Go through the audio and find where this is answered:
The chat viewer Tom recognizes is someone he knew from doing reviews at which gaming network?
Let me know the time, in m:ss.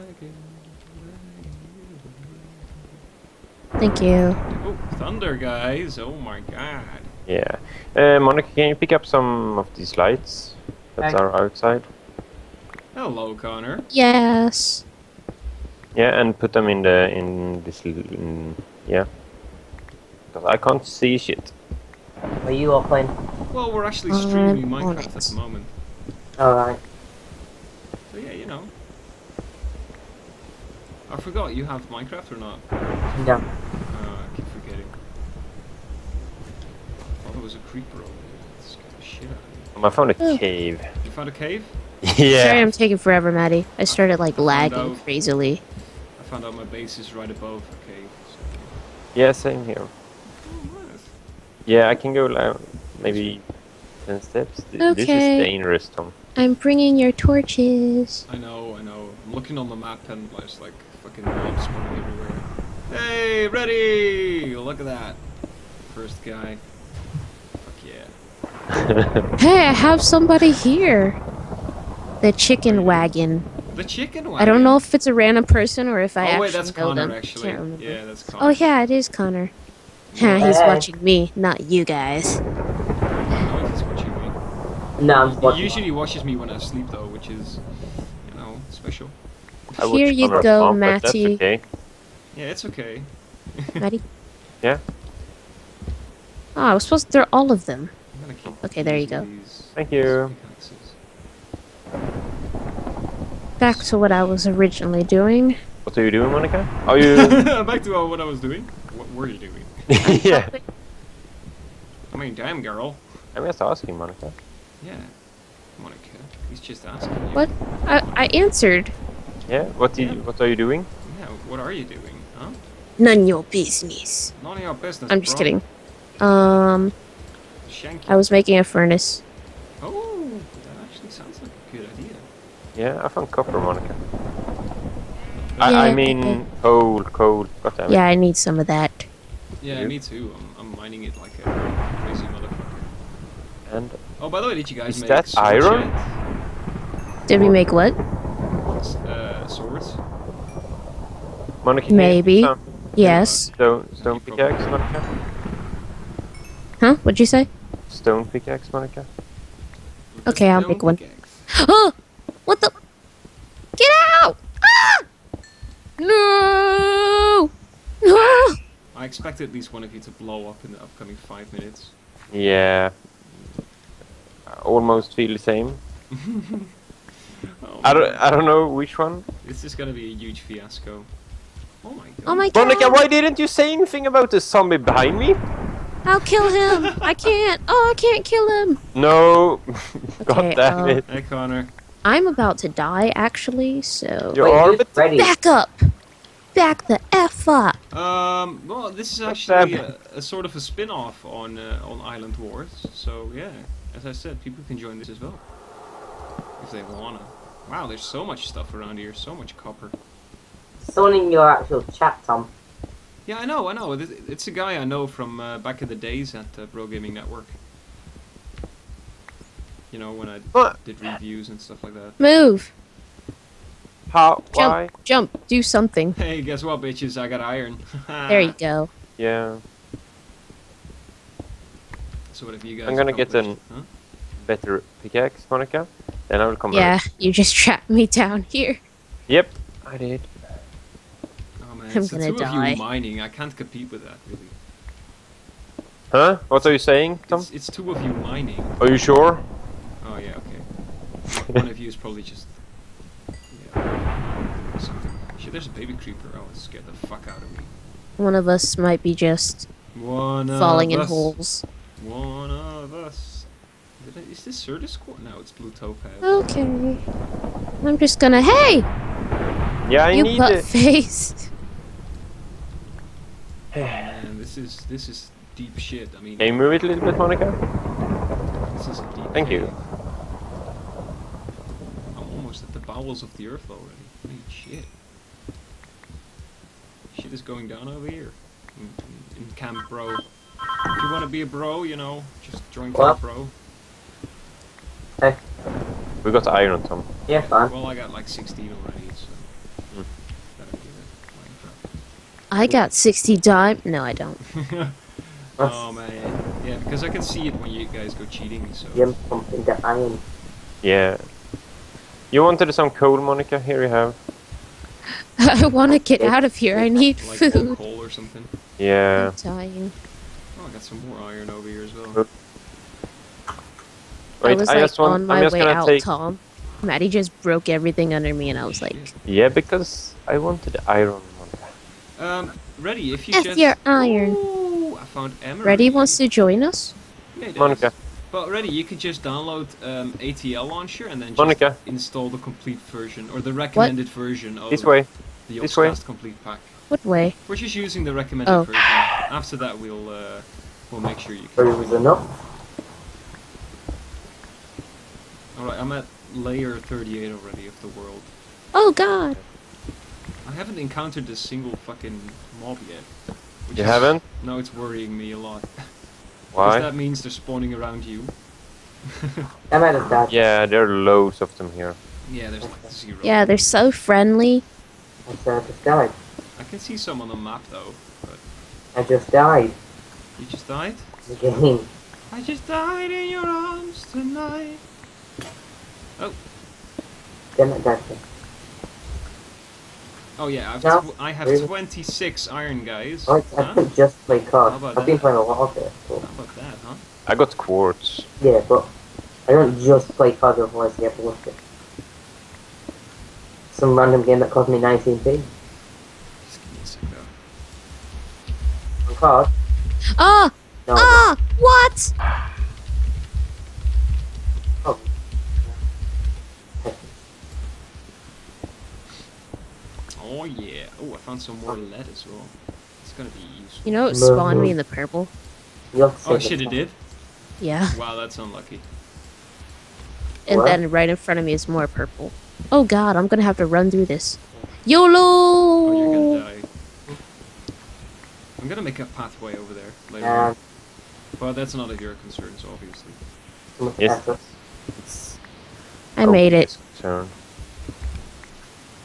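3:36.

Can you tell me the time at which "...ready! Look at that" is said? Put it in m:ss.
1:03.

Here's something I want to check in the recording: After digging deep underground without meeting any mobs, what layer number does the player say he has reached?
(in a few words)
38.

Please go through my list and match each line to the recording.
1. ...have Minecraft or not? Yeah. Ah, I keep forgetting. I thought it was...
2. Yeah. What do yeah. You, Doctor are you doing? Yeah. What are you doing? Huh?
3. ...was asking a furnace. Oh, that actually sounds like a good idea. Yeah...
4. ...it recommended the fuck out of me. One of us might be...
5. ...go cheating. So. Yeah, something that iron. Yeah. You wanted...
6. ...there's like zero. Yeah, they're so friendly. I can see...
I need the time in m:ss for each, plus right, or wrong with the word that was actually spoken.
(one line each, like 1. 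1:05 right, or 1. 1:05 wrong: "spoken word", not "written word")
1. 0:31 right
2. 1:59 wrong: "What", not "Doctor"
3. 2:08 wrong: "making", not "asking"
4. 4:16 wrong: "scared", not "recommended"
5. 5:08 right
6. 6:12 right.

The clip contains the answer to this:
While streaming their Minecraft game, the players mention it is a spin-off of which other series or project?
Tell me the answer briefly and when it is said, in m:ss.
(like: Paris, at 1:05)
Island Wars, at 3:22.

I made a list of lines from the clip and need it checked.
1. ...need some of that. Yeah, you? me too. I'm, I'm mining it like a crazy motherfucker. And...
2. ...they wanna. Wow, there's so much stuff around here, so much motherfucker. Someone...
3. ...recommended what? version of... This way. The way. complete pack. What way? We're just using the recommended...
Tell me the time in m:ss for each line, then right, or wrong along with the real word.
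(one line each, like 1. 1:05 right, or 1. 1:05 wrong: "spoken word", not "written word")
1. 2:18 right
2. 3:26 wrong: "copper", not "motherfucker"
3. 5:43 right.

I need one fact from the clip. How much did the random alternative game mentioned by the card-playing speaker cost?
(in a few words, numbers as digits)
19p.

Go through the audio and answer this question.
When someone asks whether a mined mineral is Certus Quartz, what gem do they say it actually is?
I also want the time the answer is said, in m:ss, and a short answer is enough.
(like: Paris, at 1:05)
Blue Topaz, at 4:25.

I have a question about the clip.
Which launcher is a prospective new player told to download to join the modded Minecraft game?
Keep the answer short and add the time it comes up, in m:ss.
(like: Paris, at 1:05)
ATL launcher, at 5:40.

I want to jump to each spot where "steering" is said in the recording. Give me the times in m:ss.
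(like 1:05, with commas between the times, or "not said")
not said.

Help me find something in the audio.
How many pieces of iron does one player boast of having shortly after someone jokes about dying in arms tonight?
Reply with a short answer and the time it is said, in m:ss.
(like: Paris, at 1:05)
26, at 6:31.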